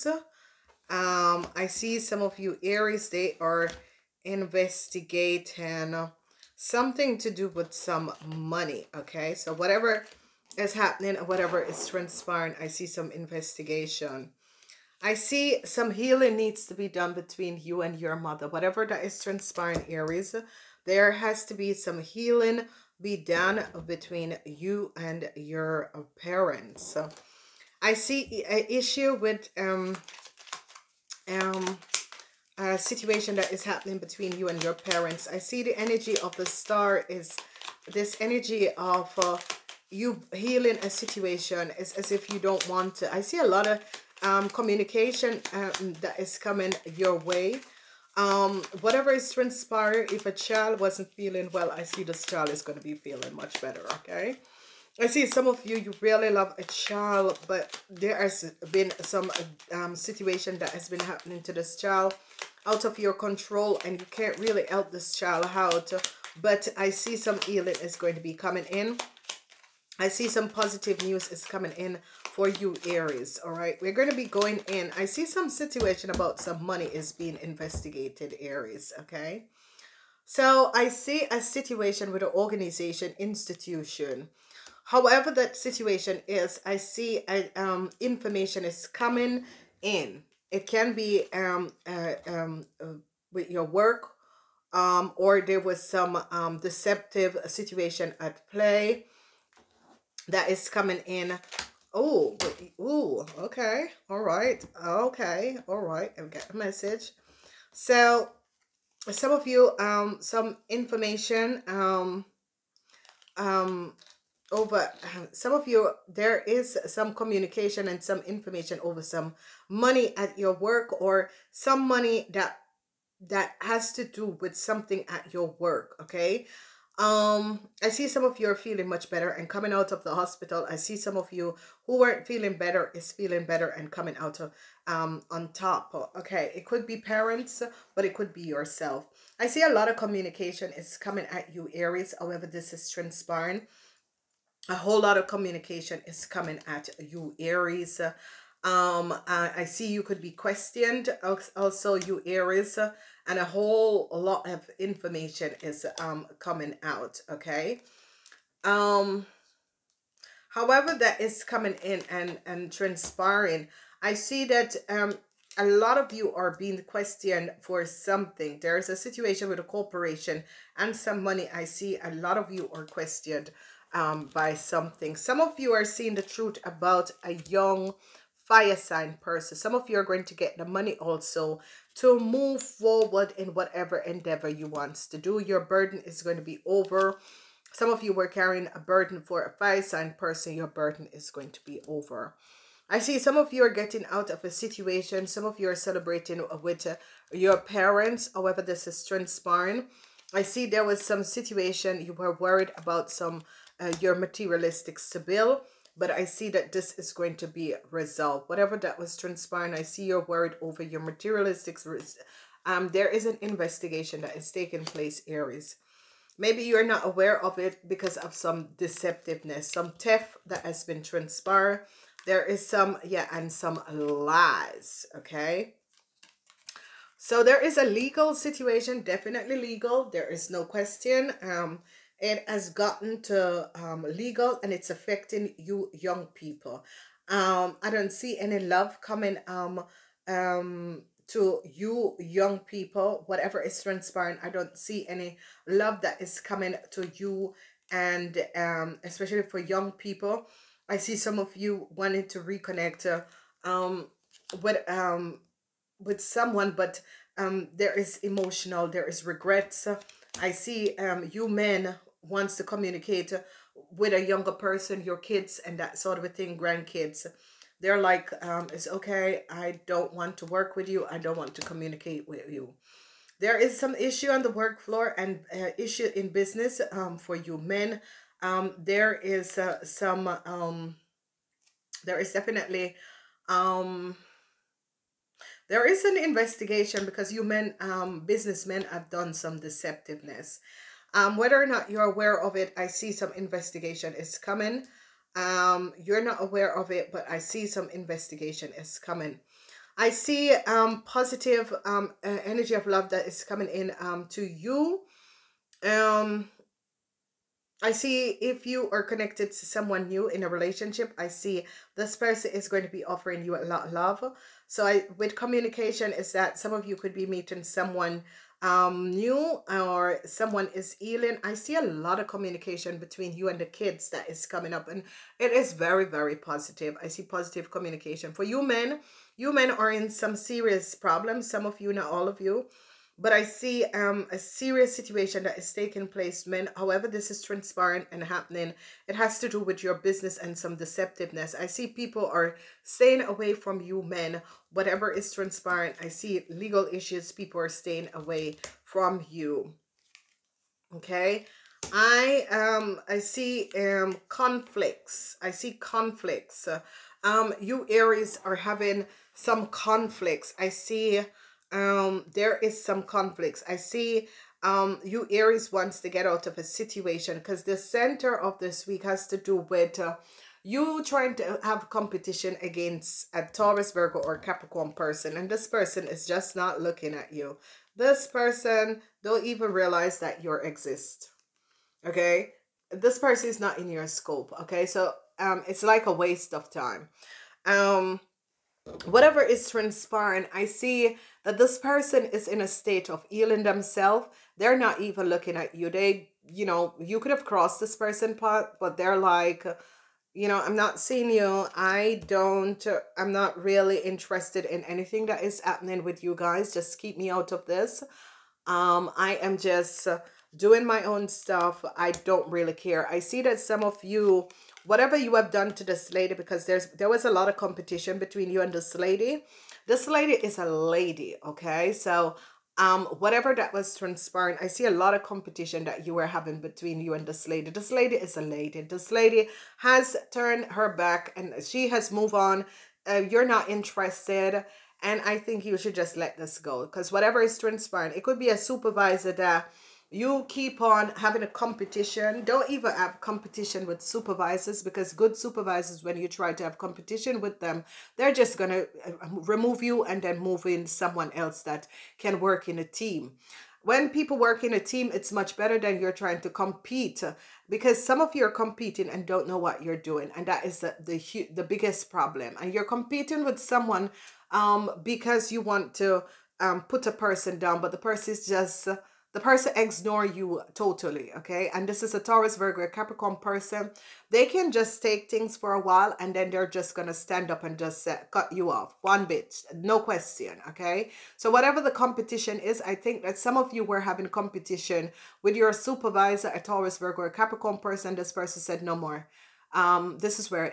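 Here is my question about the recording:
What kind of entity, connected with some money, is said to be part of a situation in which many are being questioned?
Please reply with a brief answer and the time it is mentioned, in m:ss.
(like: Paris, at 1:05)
A corporation, at 2:49.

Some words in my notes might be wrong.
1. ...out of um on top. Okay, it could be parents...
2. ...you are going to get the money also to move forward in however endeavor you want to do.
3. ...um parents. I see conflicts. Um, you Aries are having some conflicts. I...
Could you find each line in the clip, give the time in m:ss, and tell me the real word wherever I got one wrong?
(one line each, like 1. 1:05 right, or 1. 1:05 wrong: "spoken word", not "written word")
1. 2:14 right
2. 2:59 wrong: "whatever", not "however"
3. 5:53 wrong: "conflicts", not "parents".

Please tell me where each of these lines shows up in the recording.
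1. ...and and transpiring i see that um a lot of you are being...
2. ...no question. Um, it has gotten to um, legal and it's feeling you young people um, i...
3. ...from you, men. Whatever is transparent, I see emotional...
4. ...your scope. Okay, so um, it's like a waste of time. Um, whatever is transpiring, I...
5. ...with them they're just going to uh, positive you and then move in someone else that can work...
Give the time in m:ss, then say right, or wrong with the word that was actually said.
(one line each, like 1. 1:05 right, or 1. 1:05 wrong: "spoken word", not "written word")
1. 2:42 right
2. 3:50 wrong: "affecting", not "feeling"
3. 5:43 wrong: "legal", not "emotional"
4. 6:23 right
5. 7:27 wrong: "remove", not "positive".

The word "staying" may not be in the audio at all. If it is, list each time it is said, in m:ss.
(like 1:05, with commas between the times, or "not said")
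5:42, 5:47.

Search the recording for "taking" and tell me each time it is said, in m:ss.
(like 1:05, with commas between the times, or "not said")
3:34, 5:35.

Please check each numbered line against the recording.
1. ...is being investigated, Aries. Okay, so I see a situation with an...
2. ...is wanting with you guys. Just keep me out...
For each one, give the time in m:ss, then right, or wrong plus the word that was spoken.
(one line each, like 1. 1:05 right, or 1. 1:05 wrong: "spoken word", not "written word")
1. 1:16 right
2. 6:45 wrong: "happening", not "wanting".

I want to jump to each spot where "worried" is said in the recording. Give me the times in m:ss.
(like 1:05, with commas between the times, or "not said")
3:22, 3:30.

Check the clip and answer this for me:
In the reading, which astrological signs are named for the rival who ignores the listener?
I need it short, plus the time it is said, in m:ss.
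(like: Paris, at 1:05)
Taurus, Virgo, or Capricorn, at 6:13.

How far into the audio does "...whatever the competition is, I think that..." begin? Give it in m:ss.
8:01.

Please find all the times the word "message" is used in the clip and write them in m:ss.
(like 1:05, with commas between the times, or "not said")
1:46.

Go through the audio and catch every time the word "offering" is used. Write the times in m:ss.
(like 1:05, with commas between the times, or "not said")
5:13.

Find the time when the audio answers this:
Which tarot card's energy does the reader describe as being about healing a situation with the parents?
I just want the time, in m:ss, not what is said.
0:36.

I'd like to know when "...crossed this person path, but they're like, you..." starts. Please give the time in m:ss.
6:37.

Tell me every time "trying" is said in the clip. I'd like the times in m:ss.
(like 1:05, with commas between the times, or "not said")
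6:11, 7:36.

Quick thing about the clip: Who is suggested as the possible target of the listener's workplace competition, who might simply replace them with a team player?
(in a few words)
A supervisor.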